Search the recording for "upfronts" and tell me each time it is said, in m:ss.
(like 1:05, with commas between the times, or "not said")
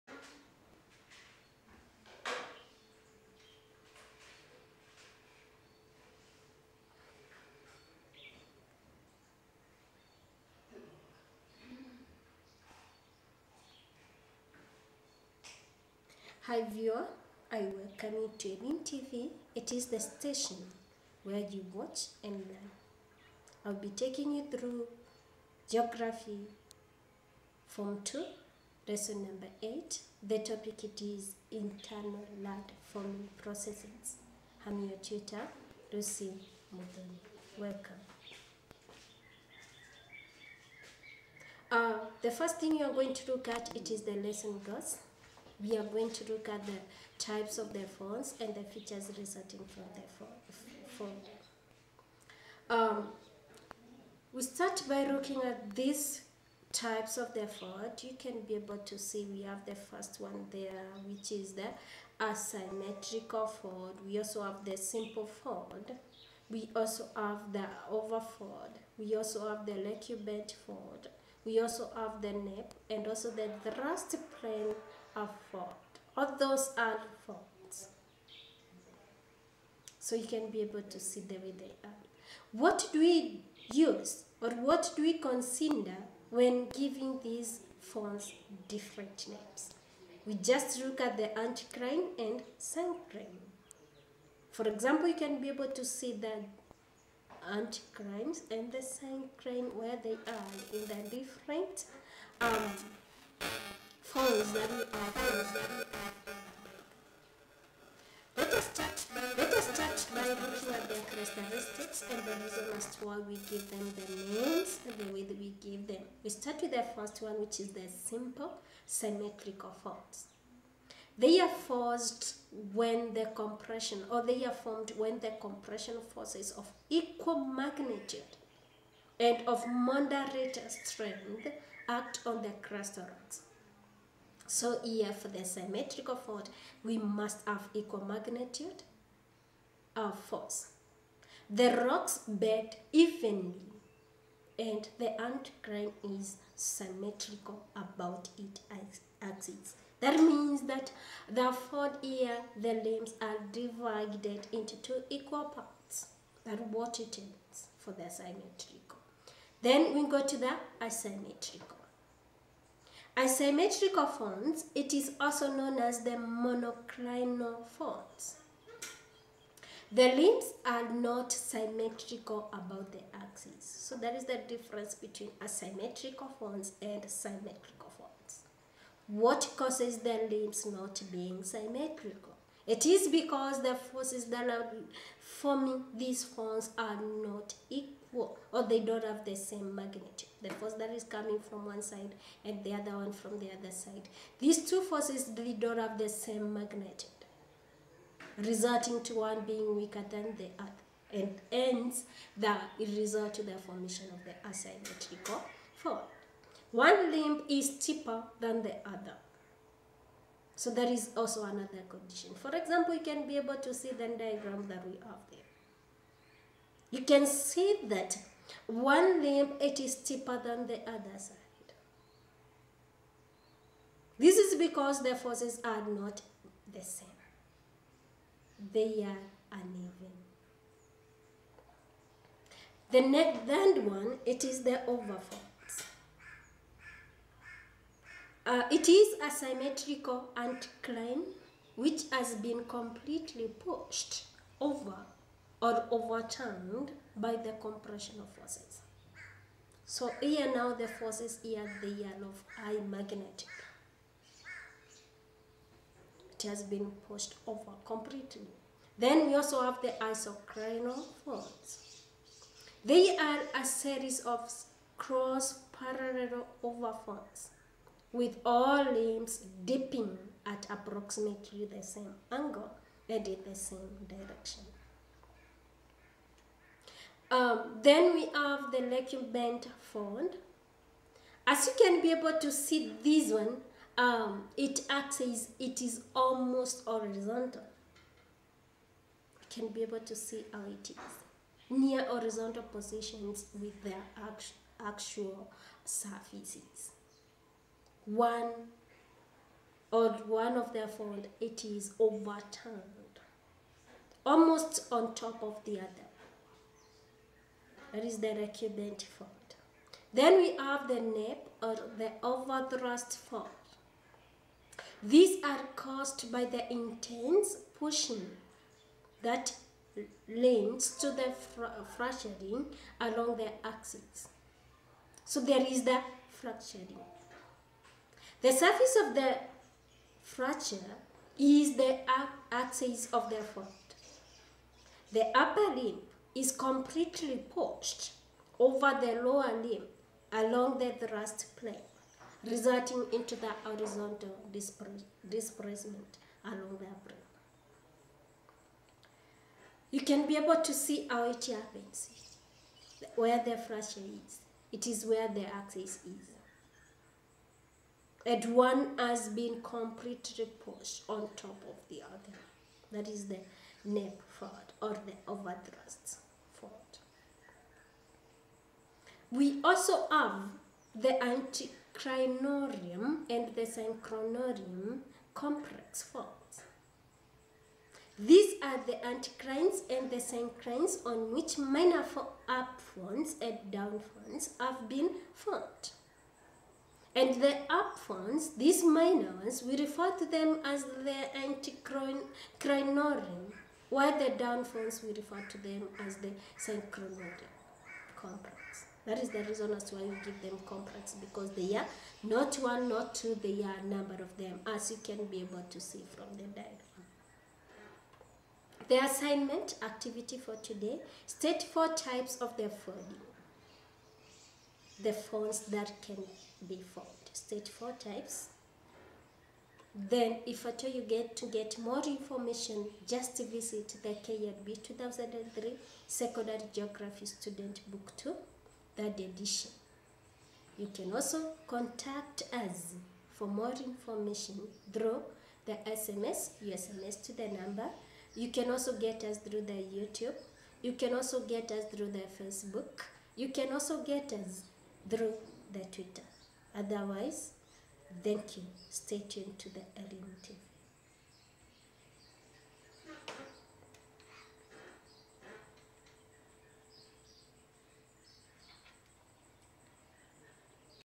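6:22, 6:27.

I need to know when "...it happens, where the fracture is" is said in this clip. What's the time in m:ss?
5:51.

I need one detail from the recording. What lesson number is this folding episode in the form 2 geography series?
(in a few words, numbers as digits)
8.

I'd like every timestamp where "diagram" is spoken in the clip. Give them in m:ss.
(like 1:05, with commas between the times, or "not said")
3:34, 6:46.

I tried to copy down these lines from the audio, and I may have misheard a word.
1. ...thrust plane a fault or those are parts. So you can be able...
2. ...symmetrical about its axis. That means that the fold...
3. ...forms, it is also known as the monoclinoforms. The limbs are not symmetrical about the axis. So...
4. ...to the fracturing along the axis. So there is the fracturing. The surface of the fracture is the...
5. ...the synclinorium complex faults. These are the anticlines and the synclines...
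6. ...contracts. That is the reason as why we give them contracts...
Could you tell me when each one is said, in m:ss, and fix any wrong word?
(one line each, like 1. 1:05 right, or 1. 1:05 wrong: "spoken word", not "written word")
1. 1:13 wrong: "faults", not "parts"
2. 2:26 right
3. 2:44 right
4. 5:20 right
5. 6:13 right
6. 6:38 right.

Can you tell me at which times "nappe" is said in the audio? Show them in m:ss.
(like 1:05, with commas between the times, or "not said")
1:12, 5:10, 6:03.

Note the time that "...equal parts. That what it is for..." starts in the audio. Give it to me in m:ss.
2:35.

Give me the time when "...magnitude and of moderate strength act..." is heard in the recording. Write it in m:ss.
2:07.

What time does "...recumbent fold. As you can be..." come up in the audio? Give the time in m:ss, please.
4:38.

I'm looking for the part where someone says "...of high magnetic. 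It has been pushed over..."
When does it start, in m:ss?
4:12.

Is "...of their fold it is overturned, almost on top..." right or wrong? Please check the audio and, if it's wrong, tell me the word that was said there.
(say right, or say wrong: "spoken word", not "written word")
right.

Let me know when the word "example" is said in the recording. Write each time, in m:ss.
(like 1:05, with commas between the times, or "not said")
1:34, 3:32.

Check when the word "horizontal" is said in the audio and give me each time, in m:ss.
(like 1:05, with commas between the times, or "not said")
4:46, 4:52, 5:43.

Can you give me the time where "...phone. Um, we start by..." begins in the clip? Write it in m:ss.
0:50.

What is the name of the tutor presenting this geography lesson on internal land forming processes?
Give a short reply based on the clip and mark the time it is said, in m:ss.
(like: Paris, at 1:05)
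Lucy Mudoni, at 0:35.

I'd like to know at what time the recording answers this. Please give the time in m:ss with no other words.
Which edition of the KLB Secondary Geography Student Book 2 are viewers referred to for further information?
7:08.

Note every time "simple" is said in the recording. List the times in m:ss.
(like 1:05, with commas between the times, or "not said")
1:04, 1:58.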